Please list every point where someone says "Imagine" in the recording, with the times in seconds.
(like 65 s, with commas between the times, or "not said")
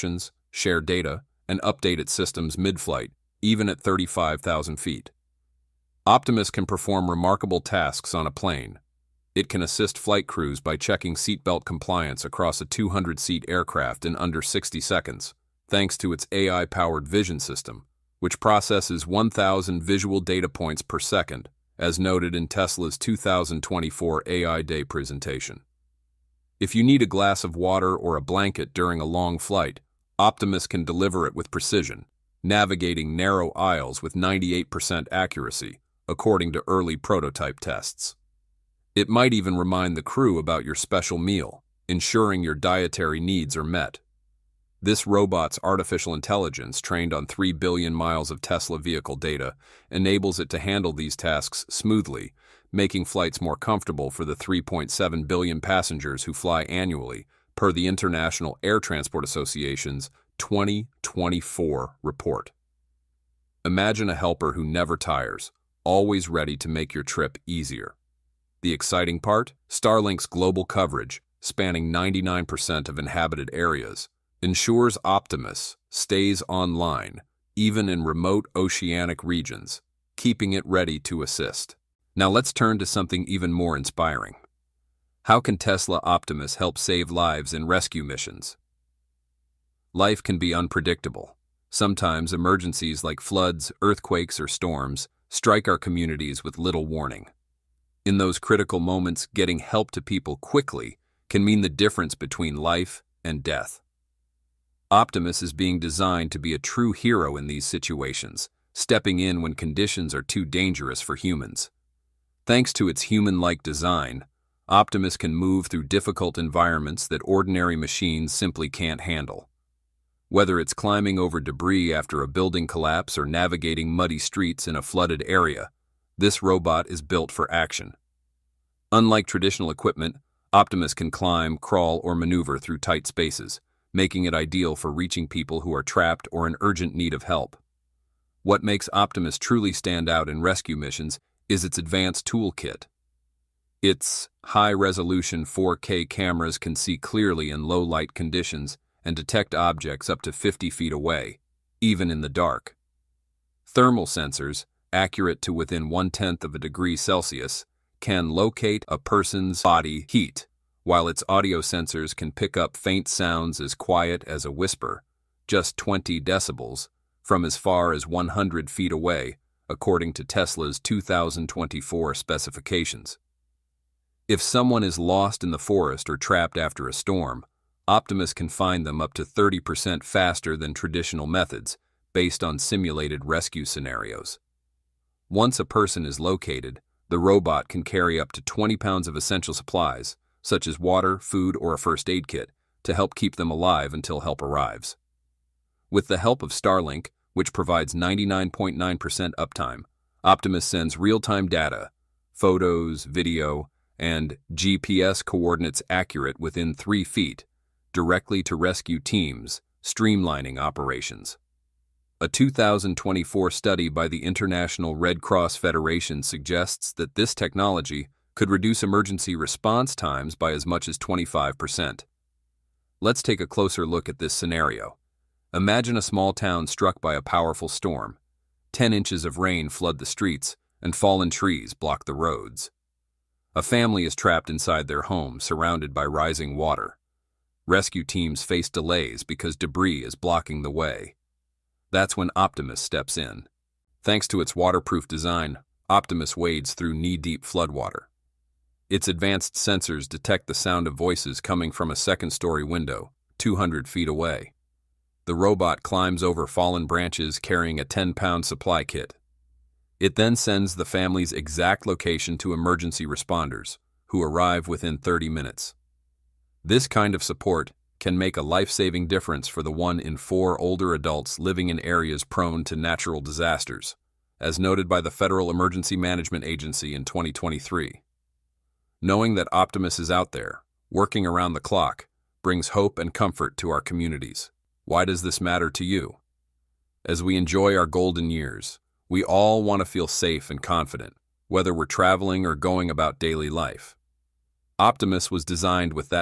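63 s, 225 s.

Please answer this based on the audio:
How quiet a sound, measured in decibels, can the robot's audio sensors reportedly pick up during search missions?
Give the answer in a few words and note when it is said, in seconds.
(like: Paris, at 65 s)
20 decibels, at 165 s.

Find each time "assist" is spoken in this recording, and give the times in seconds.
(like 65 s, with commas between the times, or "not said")
9 s, 81 s.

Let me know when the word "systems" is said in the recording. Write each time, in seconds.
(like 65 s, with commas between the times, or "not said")
2 s, 17 s.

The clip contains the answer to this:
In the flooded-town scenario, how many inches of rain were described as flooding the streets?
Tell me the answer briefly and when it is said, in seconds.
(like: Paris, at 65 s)
10 inches, at 228 s.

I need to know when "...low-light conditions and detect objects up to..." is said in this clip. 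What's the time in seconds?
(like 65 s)
147 s.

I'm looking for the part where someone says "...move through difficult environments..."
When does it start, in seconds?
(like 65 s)
115 s.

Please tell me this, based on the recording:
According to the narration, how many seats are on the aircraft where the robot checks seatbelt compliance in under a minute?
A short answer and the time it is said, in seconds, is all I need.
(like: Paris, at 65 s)
200, at 12 s.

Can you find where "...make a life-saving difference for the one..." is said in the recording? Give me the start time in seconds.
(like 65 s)
268 s.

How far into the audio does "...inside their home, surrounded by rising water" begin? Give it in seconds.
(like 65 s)
234 s.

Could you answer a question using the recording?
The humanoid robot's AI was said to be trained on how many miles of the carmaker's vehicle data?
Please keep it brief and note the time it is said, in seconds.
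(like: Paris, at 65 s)
3 billion, at 47 s.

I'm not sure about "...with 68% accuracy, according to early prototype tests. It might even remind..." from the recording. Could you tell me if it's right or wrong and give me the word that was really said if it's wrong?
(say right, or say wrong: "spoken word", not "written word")
wrong: "98", not "68".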